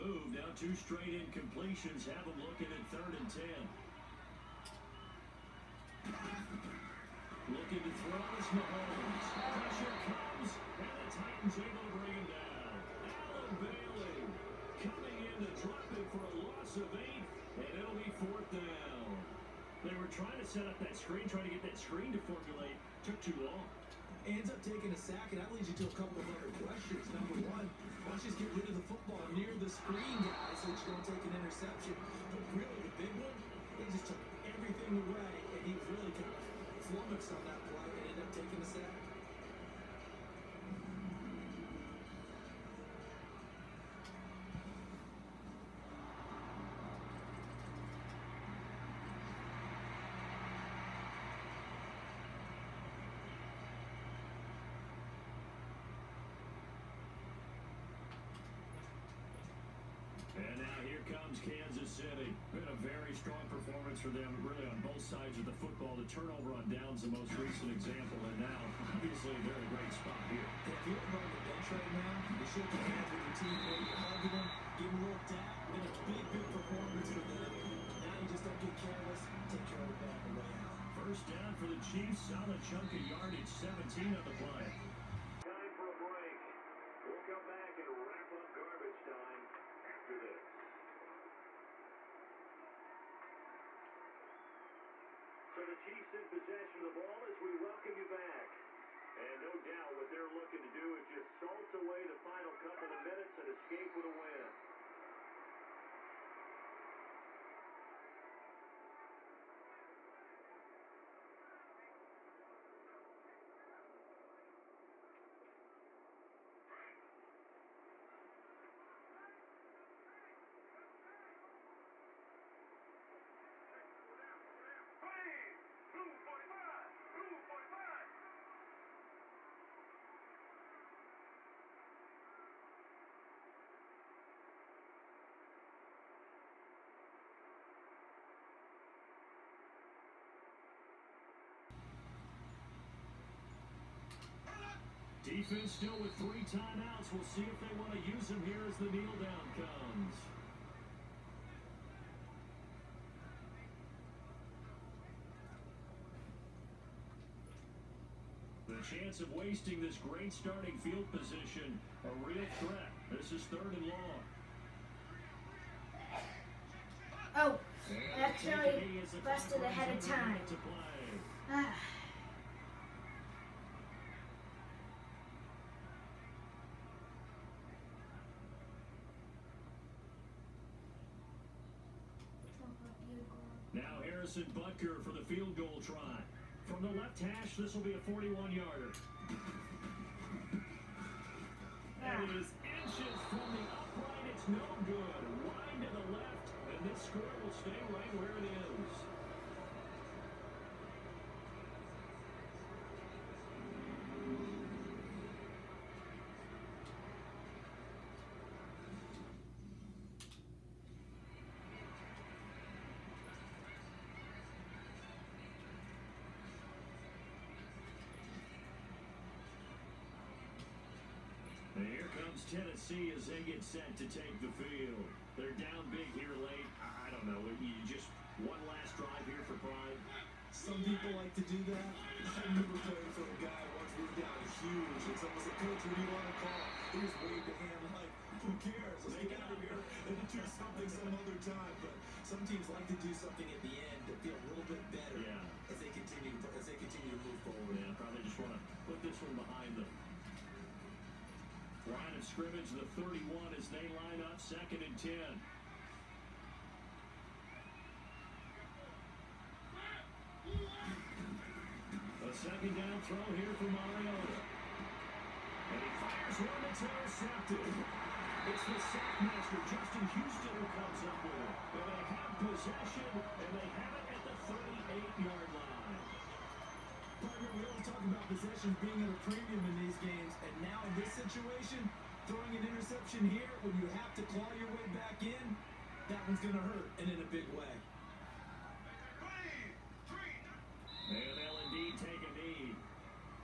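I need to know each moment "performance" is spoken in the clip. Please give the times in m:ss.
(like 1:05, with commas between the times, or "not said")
1:03, 1:16.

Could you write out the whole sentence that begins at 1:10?
If you're on the bench right now, you should be hands with your team.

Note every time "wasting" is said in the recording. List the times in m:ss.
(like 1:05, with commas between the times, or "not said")
2:39.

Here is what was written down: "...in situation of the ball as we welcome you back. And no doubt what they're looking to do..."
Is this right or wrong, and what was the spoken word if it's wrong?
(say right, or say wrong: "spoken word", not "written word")
wrong: "possession", not "situation".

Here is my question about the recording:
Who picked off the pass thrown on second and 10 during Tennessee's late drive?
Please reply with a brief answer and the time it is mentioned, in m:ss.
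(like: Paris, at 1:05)
Justin Houston, at 4:29.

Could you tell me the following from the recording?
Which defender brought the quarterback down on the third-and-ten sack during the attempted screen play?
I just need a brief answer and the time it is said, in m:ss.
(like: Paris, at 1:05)
Allen Bailey, at 0:12.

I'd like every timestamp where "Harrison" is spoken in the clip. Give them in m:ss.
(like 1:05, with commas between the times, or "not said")
3:04.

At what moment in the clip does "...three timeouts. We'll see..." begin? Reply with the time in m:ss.
2:26.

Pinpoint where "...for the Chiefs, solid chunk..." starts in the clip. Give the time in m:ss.
1:21.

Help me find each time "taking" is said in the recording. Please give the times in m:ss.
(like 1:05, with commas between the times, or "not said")
0:24, 0:38.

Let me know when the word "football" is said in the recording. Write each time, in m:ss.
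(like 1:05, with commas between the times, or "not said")
0:28, 1:05.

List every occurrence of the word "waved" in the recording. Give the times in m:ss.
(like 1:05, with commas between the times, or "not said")
3:57.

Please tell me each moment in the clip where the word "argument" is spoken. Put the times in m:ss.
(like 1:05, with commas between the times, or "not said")
not said.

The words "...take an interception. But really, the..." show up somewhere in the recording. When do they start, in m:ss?
0:31.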